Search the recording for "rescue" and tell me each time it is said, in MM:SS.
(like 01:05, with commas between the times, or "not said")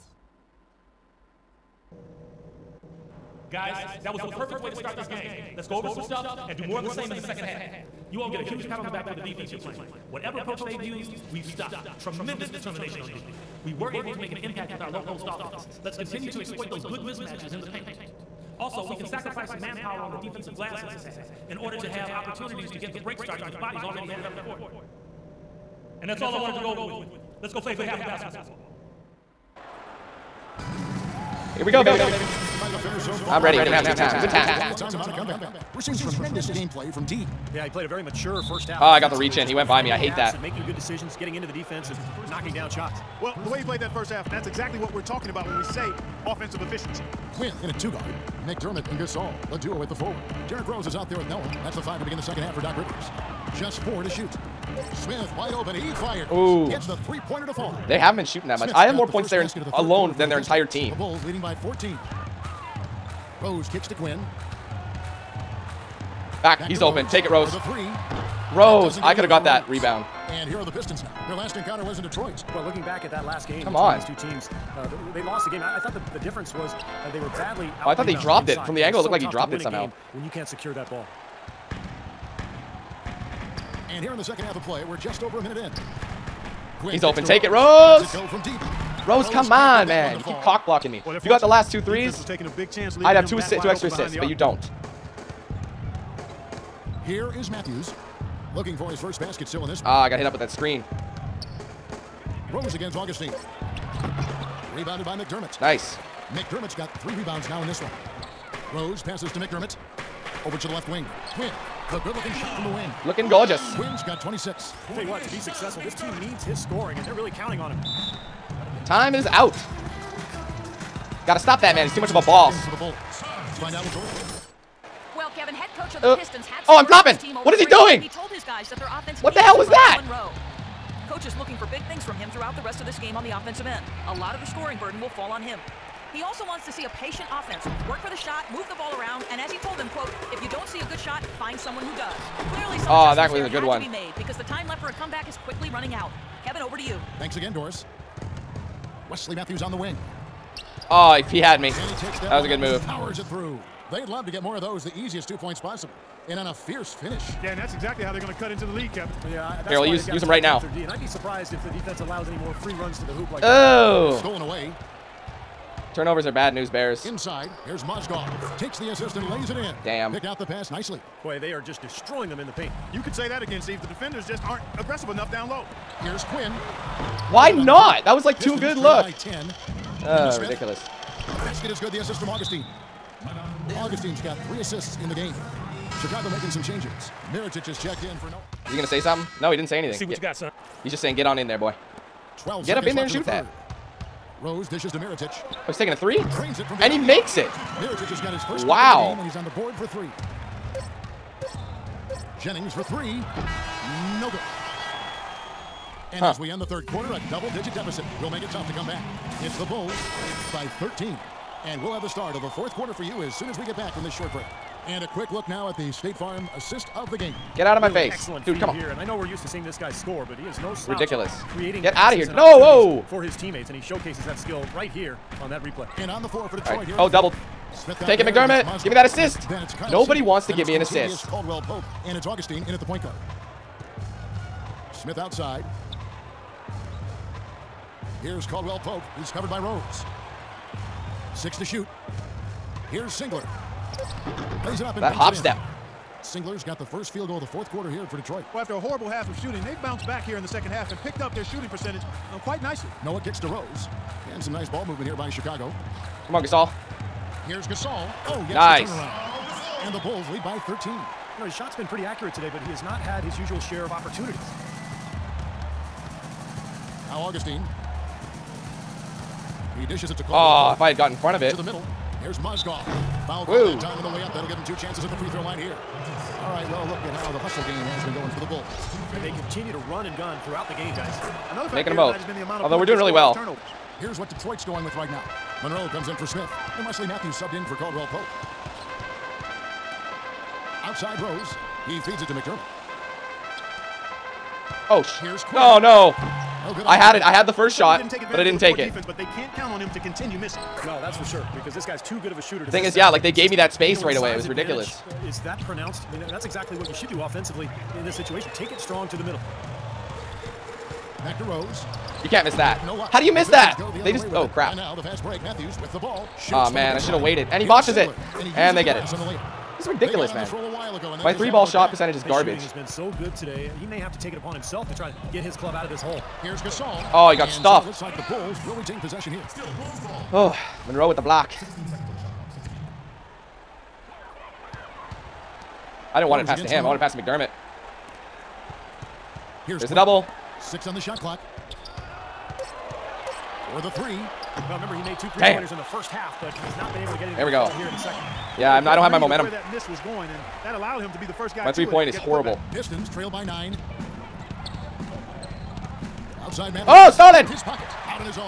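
not said.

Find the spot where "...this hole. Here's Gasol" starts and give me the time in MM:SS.
05:25.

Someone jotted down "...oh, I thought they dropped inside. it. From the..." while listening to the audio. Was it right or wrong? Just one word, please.
right.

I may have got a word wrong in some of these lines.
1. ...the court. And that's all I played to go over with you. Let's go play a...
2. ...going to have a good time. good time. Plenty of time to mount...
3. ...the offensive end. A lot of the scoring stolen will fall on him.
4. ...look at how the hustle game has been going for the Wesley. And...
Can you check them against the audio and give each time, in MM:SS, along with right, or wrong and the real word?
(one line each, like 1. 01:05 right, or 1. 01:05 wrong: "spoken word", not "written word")
1. 00:24 wrong: "wanted", not "played"
2. 00:33 right
3. 02:13 wrong: "burden", not "stolen"
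4. 04:36 wrong: "Bulls", not "Wesley".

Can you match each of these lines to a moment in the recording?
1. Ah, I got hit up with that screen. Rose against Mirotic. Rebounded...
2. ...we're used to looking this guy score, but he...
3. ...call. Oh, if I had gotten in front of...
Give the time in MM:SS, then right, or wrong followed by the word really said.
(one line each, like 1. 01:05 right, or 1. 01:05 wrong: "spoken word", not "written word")
1. 01:39 wrong: "Augustine", not "Mirotic"
2. 03:39 wrong: "seeing", not "looking"
3. 04:30 right.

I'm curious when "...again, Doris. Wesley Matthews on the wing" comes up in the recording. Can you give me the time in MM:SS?
02:27.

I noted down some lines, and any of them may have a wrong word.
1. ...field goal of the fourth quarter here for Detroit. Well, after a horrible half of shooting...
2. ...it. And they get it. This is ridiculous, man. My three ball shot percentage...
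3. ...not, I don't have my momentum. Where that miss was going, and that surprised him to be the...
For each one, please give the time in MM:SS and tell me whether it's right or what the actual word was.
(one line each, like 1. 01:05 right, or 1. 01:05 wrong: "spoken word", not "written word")
1. 04:07 right
2. 05:17 right
3. 05:48 wrong: "allowed", not "surprised".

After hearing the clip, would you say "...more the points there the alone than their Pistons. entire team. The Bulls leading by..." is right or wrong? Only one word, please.
right.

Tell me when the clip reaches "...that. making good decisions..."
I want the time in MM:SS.
00:40.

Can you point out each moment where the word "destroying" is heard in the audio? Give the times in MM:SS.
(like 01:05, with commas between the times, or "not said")
02:51.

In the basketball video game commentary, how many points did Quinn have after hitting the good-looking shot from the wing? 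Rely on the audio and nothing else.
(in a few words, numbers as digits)
26.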